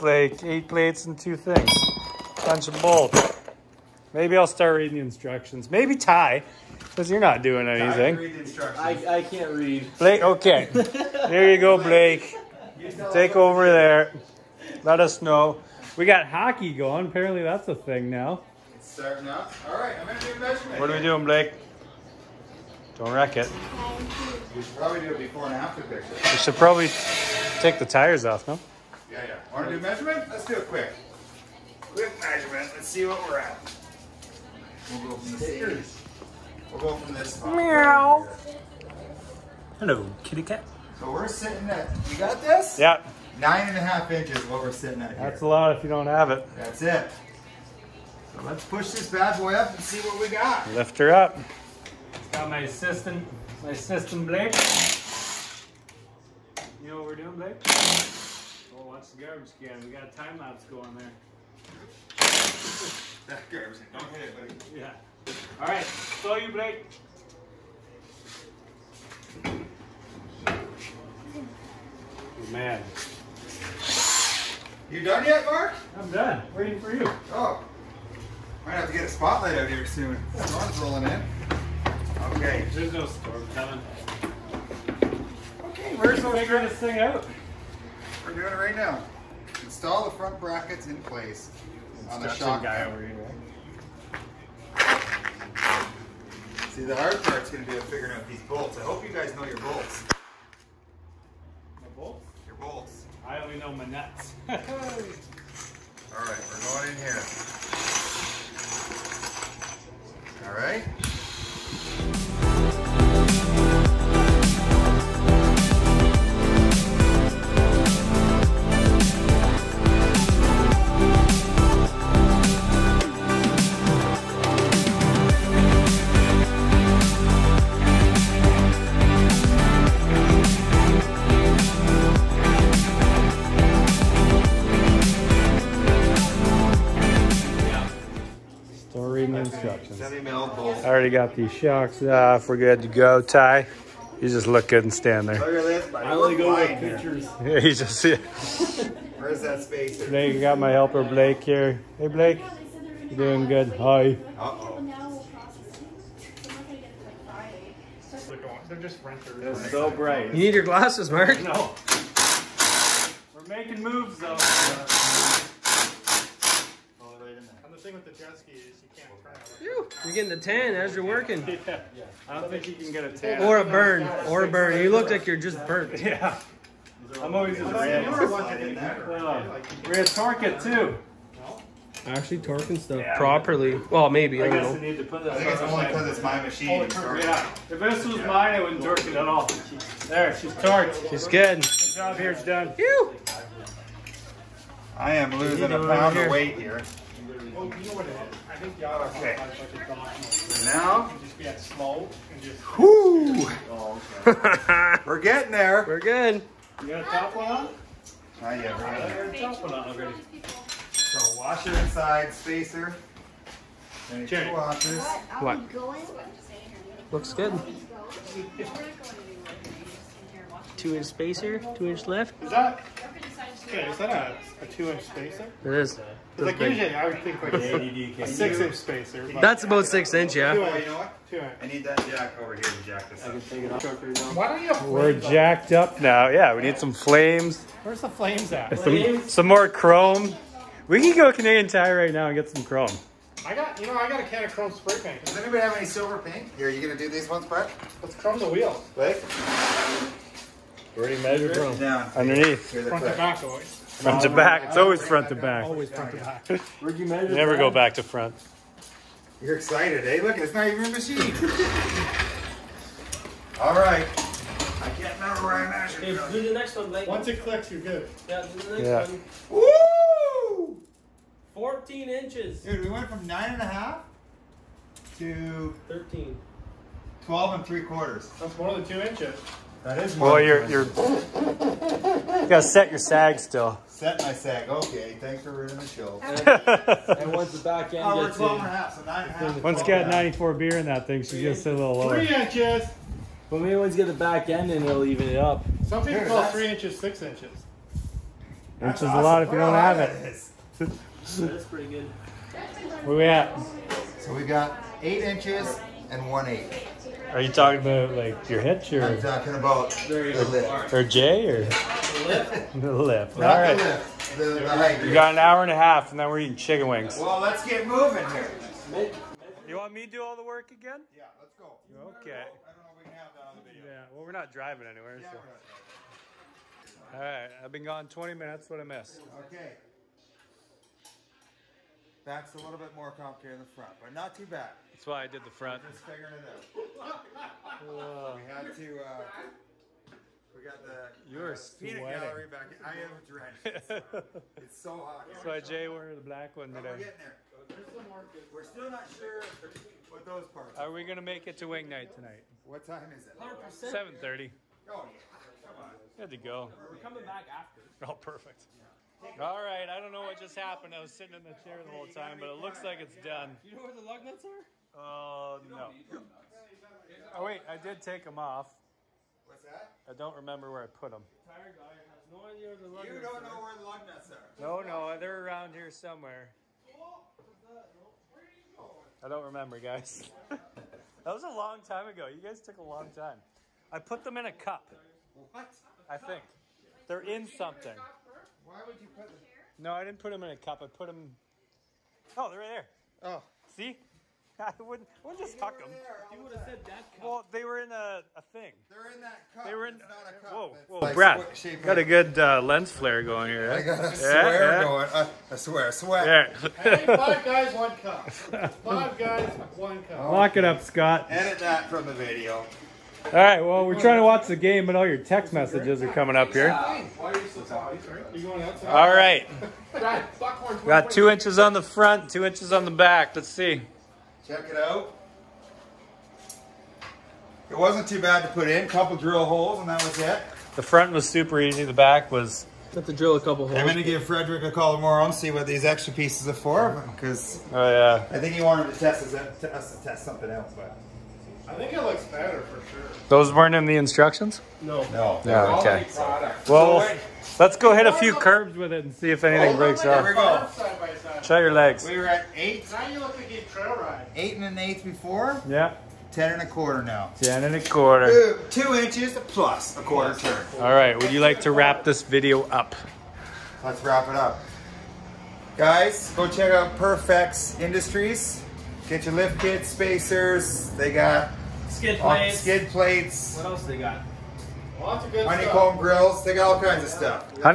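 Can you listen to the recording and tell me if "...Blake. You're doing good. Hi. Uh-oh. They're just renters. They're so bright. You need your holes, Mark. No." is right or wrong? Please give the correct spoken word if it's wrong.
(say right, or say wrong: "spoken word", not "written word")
wrong: "glasses", not "holes".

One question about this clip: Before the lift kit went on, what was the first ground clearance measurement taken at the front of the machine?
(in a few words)
9.5 inches.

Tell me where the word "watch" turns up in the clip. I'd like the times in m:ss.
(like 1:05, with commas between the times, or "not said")
0:58, 6:54.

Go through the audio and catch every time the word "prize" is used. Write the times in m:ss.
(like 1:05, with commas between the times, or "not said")
not said.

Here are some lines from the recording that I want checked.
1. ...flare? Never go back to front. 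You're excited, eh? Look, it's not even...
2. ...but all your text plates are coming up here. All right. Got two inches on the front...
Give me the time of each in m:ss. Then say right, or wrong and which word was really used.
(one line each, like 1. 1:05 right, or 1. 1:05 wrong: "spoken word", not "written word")
1. 4:17 wrong: "measure", not "flare"
2. 6:54 wrong: "messages", not "plates".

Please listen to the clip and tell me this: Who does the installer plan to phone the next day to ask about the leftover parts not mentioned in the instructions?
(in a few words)
Frederick.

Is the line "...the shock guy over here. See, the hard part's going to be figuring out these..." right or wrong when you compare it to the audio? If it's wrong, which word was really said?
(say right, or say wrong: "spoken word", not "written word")
right.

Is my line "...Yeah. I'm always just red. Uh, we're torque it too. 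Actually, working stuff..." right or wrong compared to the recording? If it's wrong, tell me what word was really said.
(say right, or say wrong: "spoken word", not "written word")
wrong: "torquing", not "working".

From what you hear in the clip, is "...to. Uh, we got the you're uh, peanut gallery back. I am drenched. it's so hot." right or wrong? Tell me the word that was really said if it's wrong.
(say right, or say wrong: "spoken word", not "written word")
right.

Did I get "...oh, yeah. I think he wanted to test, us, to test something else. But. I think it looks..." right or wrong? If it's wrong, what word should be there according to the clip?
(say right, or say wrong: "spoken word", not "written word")
right.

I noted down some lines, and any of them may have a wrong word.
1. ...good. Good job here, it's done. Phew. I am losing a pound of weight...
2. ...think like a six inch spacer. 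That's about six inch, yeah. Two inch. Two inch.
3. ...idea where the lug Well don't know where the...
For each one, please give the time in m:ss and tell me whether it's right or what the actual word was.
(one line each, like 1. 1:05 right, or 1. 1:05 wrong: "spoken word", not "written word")
1. 3:11 right
2. 3:47 right
3. 6:12 wrong: "You", not "Well".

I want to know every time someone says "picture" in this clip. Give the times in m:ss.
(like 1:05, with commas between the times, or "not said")
0:25, 2:26.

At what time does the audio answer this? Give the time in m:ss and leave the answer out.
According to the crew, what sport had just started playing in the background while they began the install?
0:16.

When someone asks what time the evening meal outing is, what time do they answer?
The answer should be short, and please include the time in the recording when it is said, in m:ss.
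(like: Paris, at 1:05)
7:30, at 5:53.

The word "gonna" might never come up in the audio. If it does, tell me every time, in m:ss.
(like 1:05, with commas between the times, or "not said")
4:06, 4:51, 5:51.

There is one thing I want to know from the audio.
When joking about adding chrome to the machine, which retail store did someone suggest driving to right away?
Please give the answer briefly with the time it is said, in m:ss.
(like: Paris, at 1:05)
Canadian Tire, at 4:01.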